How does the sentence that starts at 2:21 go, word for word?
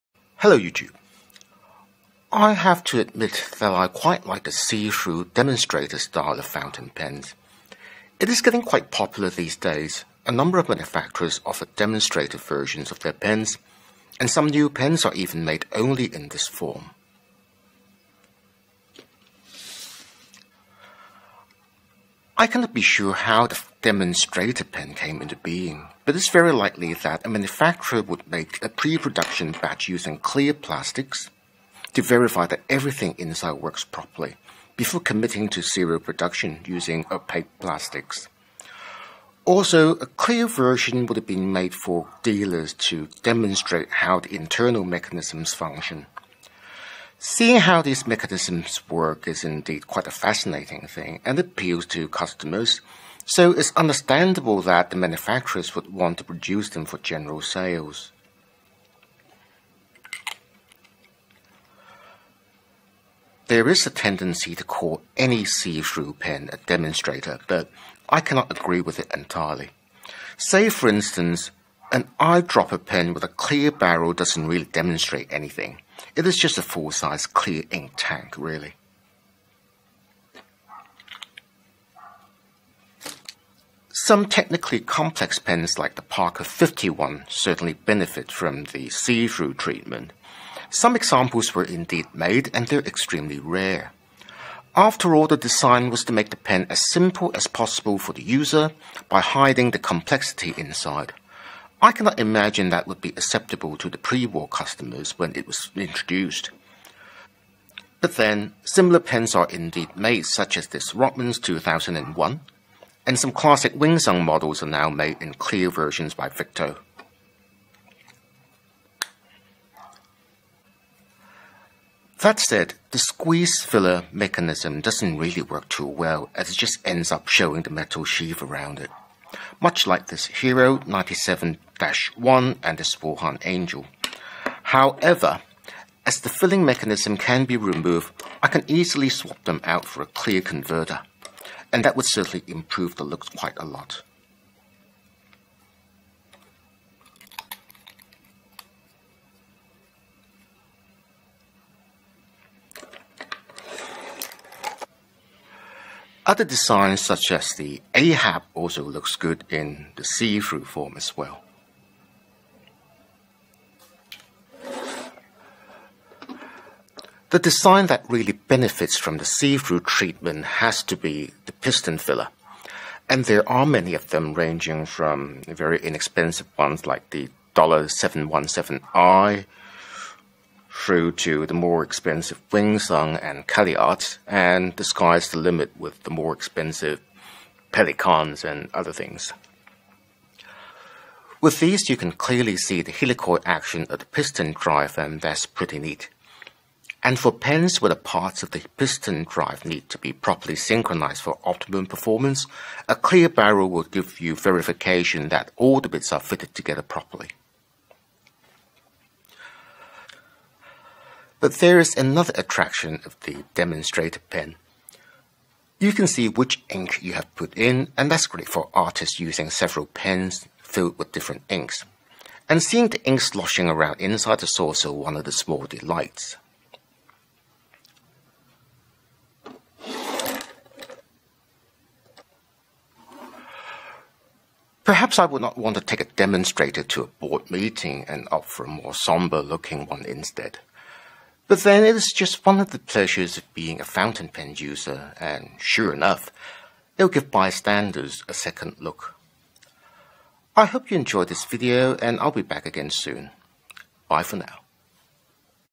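And that would certainly improve the looks quite a lot.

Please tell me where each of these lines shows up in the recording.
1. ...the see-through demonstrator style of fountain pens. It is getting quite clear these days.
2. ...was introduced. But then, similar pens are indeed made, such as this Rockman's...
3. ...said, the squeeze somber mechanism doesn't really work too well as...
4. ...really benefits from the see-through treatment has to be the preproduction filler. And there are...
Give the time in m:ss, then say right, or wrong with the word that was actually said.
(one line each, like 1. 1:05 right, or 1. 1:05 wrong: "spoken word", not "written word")
1. 0:04 wrong: "popular", not "clear"
2. 1:45 right
3. 2:02 wrong: "filler", not "somber"
4. 2:48 wrong: "piston", not "preproduction".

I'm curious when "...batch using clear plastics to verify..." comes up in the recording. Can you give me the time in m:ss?
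0:29.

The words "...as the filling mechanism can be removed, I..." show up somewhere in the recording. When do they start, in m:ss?
2:16.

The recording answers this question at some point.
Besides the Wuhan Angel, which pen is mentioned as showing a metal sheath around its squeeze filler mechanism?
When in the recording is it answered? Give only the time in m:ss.
2:10.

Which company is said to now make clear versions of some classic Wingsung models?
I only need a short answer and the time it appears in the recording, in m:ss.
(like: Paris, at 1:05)
Victor, at 1:56.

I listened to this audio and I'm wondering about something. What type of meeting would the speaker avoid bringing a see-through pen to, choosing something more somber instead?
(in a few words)
board meeting.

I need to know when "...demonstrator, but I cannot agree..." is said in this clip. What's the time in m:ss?
1:06.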